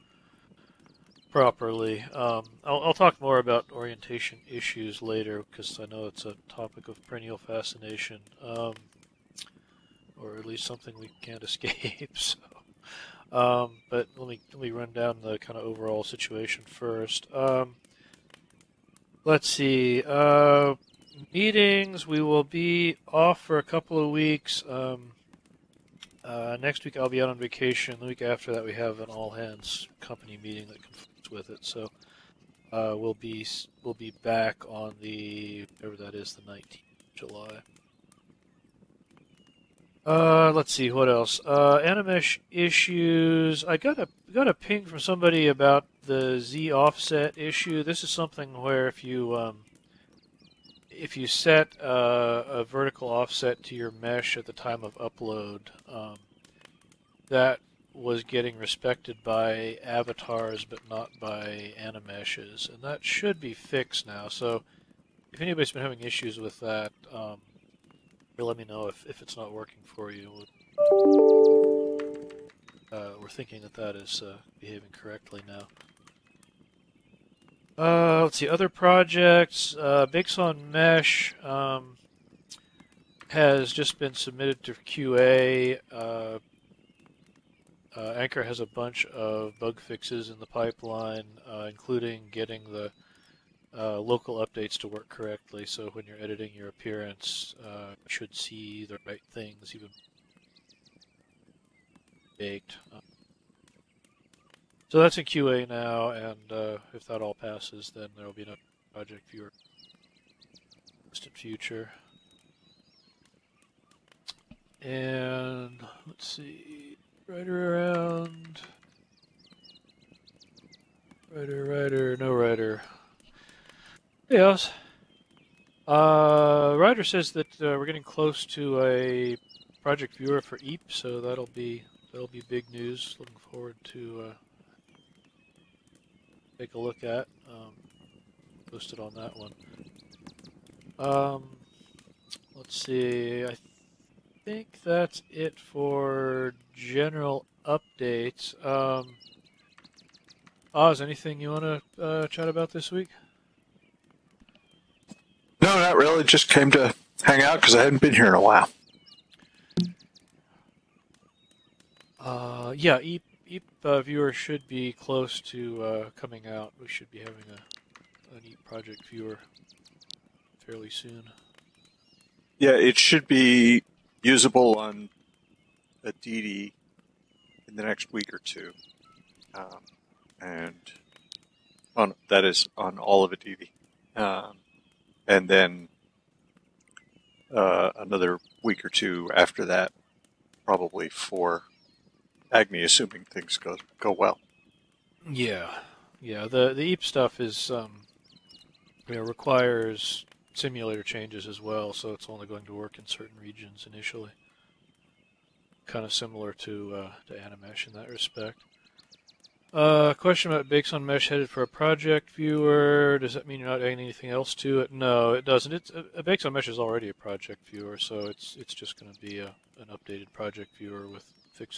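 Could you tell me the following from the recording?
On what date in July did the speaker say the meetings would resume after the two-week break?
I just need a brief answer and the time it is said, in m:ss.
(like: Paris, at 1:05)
19th, at 0:36.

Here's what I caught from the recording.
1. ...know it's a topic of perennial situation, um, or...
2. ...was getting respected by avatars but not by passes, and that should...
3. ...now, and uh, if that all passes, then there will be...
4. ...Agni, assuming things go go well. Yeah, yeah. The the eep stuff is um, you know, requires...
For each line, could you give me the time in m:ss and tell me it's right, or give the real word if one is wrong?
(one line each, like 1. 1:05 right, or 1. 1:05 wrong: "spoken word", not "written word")
1. 0:05 wrong: "fascination", not "situation"
2. 0:57 wrong: "animeshes", not "passes"
3. 1:45 right
4. 3:12 right.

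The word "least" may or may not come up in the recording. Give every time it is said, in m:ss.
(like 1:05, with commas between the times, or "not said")
0:10.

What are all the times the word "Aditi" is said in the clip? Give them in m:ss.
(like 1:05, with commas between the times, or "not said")
2:56, 3:03.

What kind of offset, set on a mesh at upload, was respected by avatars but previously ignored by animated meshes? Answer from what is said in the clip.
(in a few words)
Z offset.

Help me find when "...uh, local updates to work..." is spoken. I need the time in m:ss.
1:33.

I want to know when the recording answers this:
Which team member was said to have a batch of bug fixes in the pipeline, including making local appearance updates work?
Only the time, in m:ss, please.
1:28.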